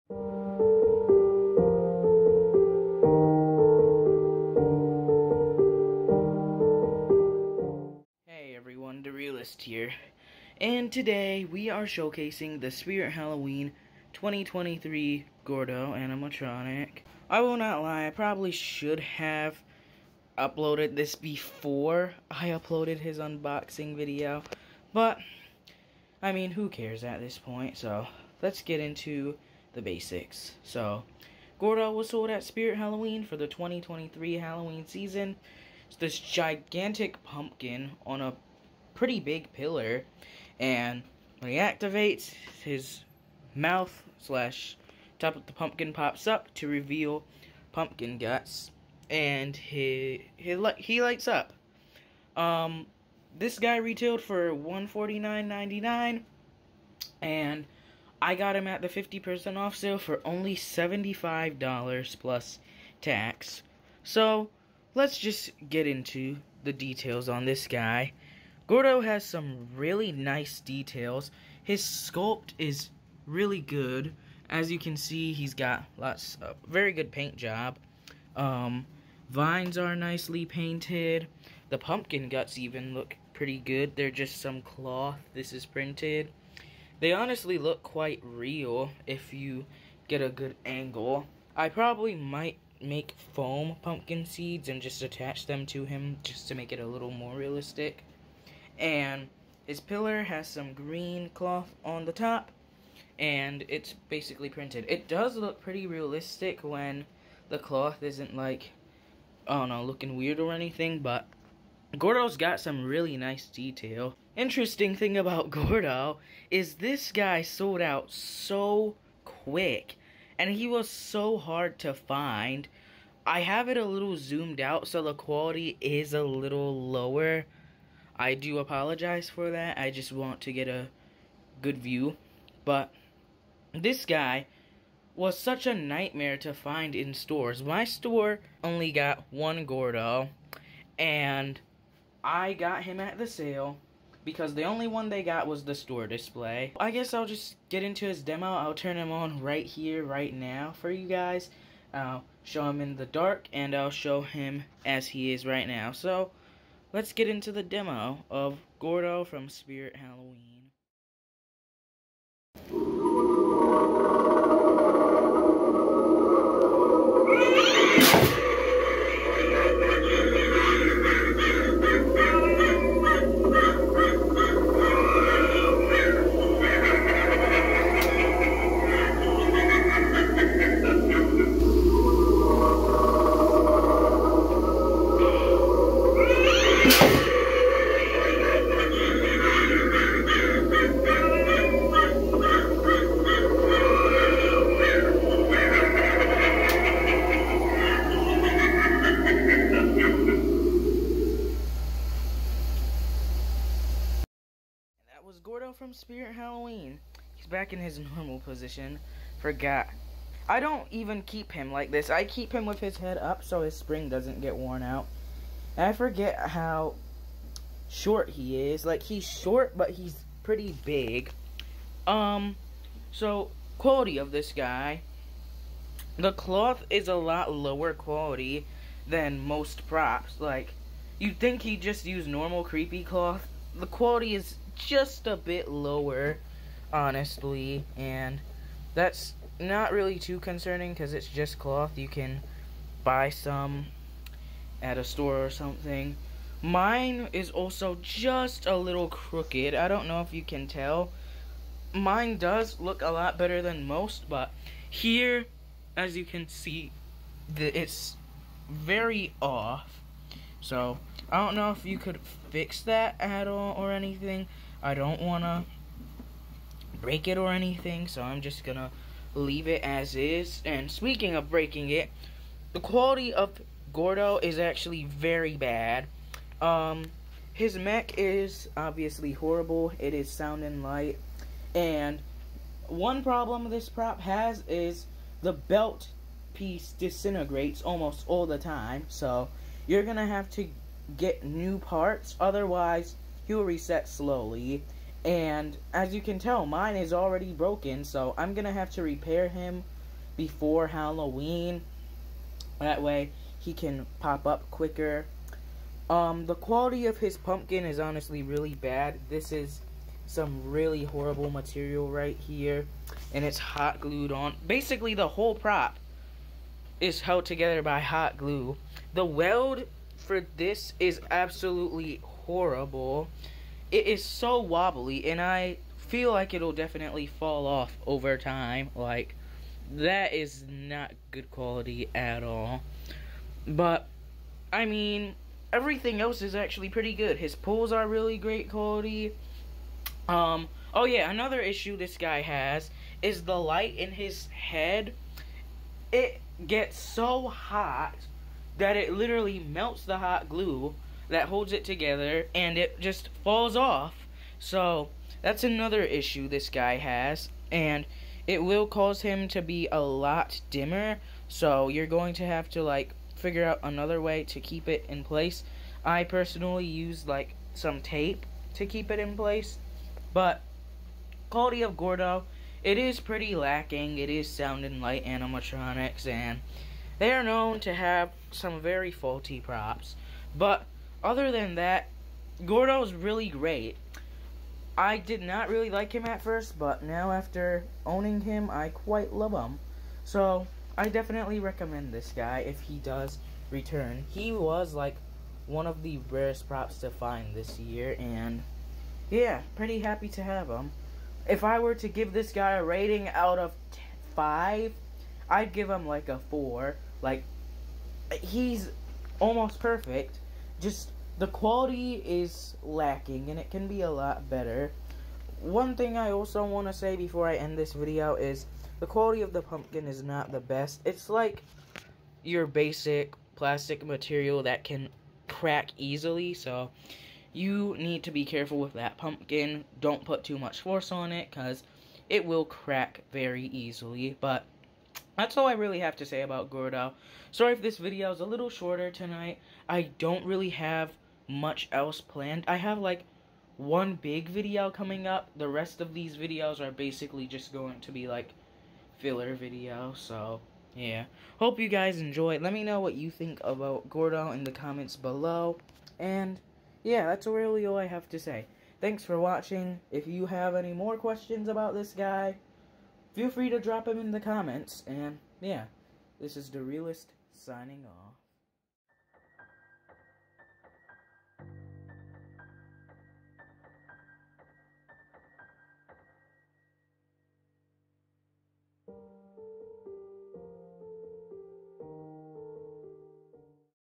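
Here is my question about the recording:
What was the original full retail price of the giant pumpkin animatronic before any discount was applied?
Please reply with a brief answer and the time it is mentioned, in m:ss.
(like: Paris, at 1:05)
$149.99, at 0:54.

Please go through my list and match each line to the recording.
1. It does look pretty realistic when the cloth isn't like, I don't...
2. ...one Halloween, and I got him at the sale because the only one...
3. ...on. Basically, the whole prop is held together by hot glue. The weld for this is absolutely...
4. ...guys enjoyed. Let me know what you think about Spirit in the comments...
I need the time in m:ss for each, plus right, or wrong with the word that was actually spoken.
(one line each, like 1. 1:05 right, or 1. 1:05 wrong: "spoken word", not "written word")
1. 1:44 right
2. 2:19 wrong: "Gourdo", not "Halloween"
3. 5:14 right
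4. 7:31 wrong: "Gourdo", not "Spirit".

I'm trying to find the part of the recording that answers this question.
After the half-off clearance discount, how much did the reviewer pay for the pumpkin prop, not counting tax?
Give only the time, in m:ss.
1:00.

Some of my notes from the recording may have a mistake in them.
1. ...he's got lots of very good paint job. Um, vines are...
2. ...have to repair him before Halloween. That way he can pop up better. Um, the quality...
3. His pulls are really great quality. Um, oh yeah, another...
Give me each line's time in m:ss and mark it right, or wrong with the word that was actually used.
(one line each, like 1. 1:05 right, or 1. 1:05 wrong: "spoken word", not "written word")
1. 1:15 right
2. 4:58 wrong: "quicker", not "better"
3. 5:37 right.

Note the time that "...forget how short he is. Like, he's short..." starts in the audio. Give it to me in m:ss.
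3:35.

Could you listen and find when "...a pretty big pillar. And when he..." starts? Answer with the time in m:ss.
0:38.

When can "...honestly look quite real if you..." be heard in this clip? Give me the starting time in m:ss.
1:27.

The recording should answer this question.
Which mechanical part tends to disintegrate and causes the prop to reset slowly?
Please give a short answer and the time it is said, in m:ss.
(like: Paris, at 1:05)
the belt piece, at 4:45.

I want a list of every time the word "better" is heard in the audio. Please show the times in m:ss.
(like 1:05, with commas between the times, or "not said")
4:13, 6:54.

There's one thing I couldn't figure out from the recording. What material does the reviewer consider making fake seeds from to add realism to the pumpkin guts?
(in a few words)
foam.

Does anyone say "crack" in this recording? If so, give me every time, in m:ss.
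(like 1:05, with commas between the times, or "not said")
7:05, 7:12.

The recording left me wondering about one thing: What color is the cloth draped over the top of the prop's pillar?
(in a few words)
green.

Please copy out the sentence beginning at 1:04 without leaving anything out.
So let's just get into the details on this guy.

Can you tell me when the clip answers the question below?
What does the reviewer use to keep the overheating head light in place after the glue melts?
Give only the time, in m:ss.
6:08.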